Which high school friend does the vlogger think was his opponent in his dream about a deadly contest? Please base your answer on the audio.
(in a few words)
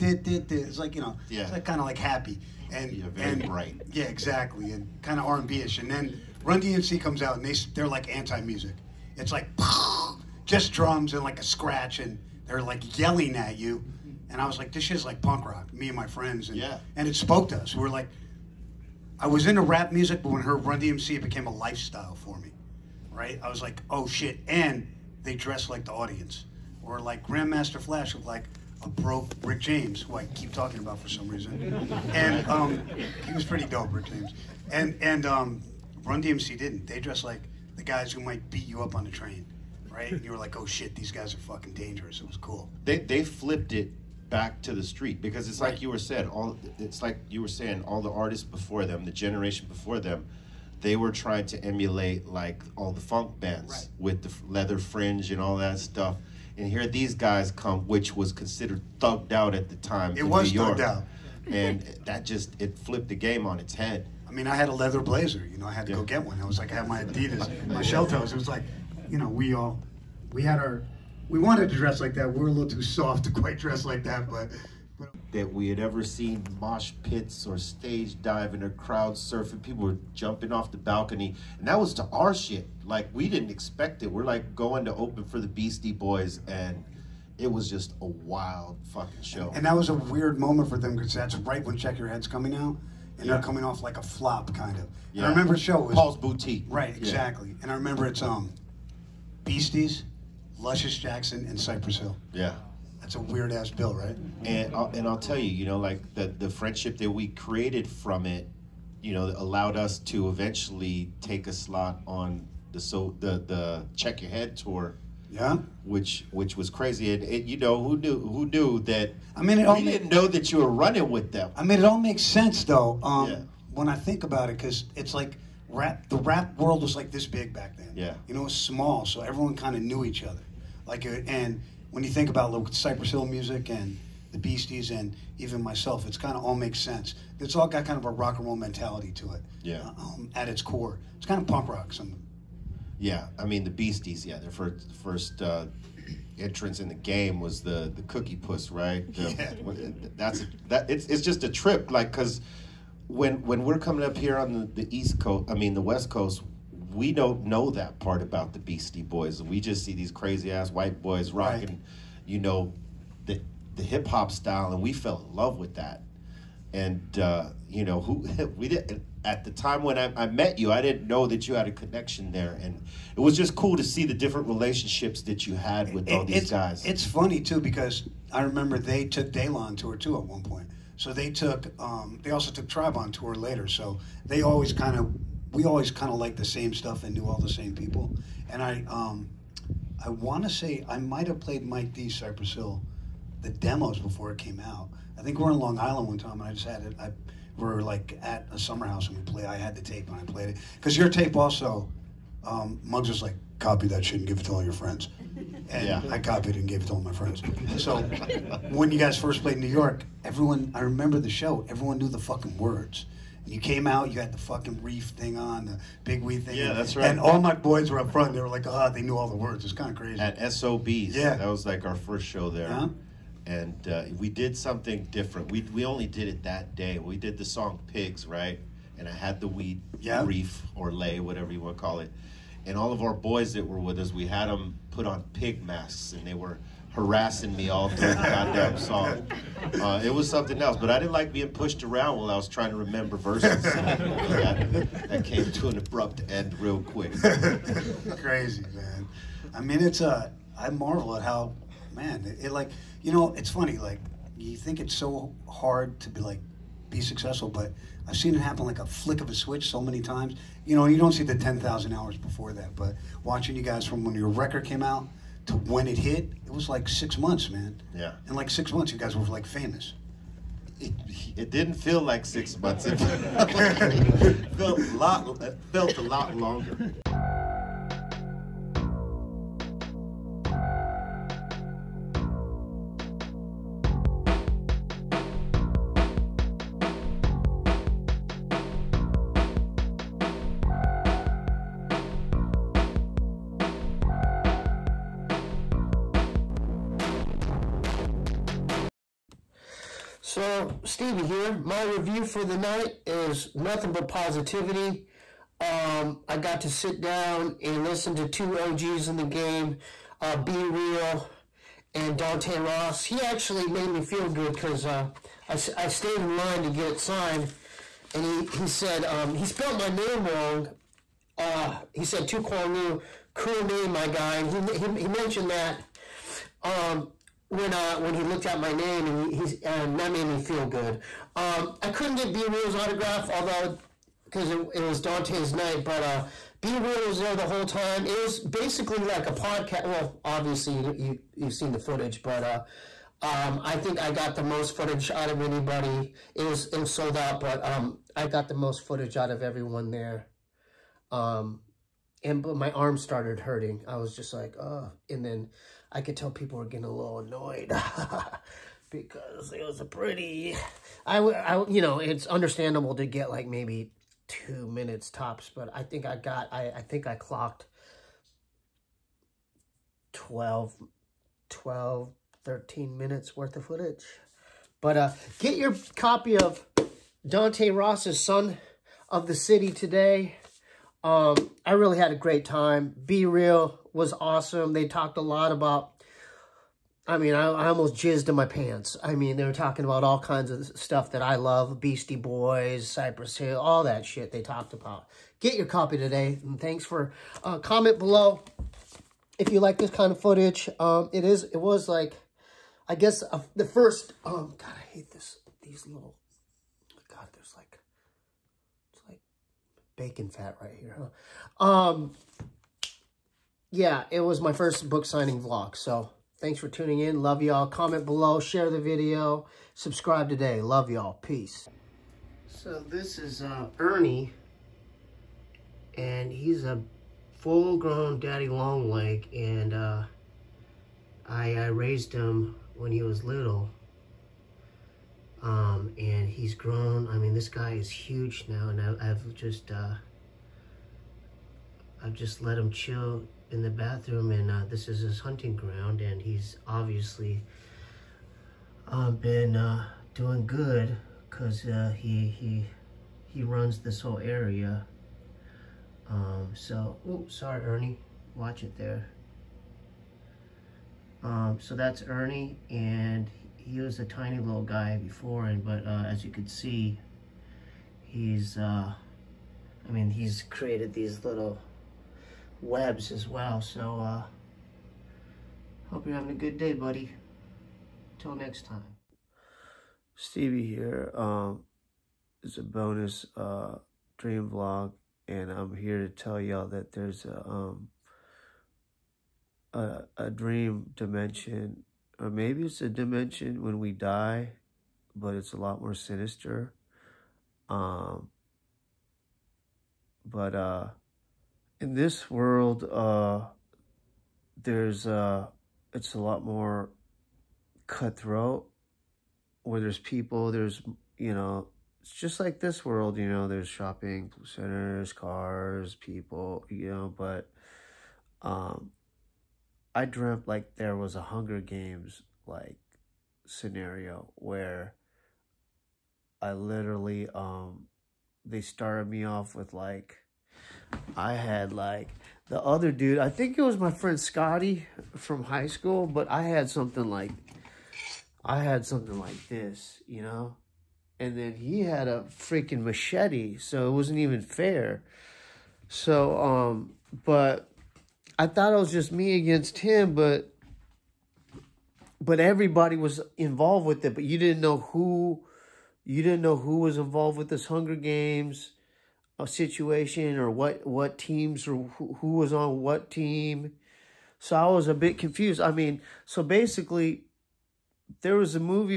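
Scotty.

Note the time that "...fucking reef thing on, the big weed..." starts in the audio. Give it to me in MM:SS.
03:34.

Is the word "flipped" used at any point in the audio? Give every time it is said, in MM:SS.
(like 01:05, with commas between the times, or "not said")
00:43, 01:02.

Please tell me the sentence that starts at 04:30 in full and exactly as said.
It, it didn't feel like six months.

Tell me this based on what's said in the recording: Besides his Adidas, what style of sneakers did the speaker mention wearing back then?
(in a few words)
shell toes.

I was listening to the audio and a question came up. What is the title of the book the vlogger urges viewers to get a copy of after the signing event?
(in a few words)
Son of the City.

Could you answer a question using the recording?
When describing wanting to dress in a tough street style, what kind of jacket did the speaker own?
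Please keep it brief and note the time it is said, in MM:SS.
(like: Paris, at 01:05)
leather blazer, at 01:04.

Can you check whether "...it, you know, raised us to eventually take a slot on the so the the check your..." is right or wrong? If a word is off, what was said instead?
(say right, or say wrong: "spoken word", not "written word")
wrong: "allowed", not "raised".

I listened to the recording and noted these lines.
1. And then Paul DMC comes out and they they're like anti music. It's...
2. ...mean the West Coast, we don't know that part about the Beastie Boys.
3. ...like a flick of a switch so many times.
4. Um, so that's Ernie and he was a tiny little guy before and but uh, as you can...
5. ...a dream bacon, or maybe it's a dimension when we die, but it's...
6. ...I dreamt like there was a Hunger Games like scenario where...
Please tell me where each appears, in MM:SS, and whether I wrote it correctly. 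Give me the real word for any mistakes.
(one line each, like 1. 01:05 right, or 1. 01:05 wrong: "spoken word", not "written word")
1. 00:05 wrong: "Run", not "Paul"
2. 02:35 right
3. 04:18 right
4. 07:41 right
5. 08:10 wrong: "dimension", not "bacon"
6. 08:39 right.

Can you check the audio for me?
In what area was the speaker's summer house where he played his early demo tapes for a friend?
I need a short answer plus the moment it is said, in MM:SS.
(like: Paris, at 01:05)
Long Island, at 03:15.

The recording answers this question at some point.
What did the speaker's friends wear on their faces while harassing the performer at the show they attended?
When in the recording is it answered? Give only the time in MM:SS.
03:55.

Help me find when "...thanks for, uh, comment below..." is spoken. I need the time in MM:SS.
06:36.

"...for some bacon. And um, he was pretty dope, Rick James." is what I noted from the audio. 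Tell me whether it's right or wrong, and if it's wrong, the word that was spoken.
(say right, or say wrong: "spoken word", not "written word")
wrong: "reason", not "bacon".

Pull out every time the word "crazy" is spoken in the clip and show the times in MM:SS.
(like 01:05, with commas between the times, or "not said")
01:56, 02:40, 03:39, 04:08.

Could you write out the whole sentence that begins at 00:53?
with the leather fringe and all that stuff.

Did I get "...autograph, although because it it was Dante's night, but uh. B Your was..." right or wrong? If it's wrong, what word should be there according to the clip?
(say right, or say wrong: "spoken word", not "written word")
wrong: "Real", not "Your".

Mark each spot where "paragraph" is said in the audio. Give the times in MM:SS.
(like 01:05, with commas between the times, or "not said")
not said.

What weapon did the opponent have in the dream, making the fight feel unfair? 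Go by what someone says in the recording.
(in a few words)
machete.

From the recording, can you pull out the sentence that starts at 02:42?
you know, the the hip hop style, and we fell in love with that.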